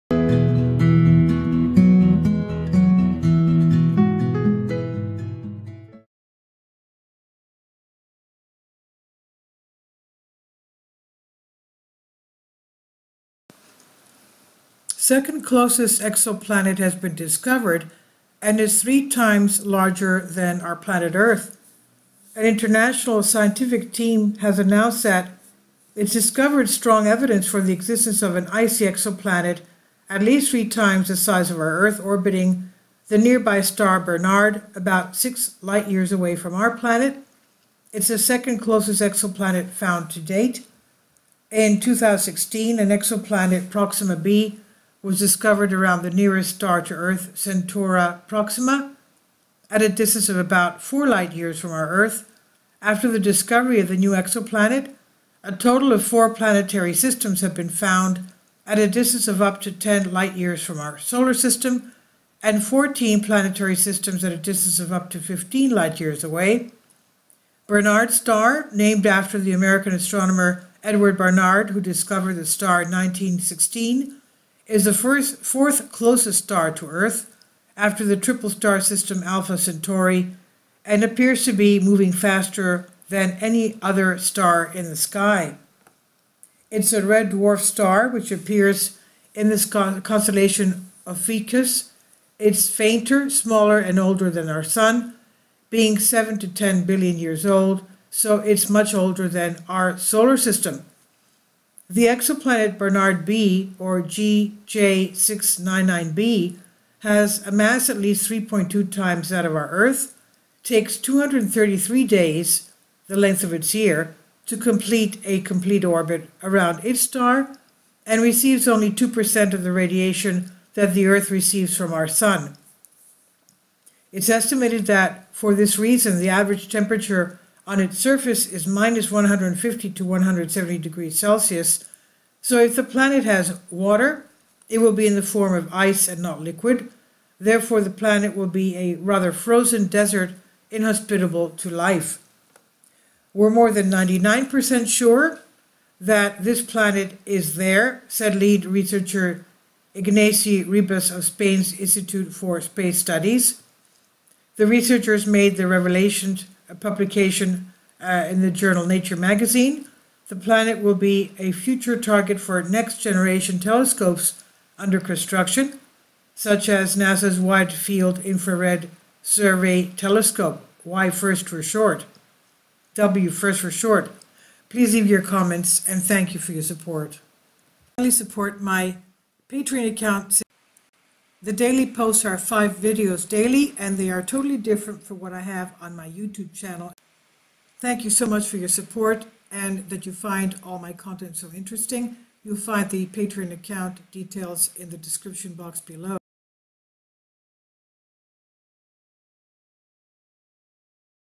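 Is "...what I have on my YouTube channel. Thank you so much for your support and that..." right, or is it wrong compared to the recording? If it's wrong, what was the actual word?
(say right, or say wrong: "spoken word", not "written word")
right.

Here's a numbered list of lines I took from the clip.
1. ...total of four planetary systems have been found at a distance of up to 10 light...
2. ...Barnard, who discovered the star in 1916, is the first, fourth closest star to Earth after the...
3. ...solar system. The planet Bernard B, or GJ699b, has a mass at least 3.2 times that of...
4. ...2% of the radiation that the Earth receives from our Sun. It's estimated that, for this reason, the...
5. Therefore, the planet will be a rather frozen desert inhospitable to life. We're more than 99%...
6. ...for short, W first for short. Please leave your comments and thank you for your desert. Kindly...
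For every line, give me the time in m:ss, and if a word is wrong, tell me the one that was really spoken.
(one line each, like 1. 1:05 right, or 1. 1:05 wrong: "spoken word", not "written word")
1. 0:55 right
2. 1:11 right
3. 1:39 wrong: "exoplanet", not "planet"
4. 1:58 right
5. 2:17 right
6. 2:51 wrong: "support", not "desert".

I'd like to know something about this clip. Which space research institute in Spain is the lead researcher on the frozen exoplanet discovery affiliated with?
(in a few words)
Institute for Space Studies.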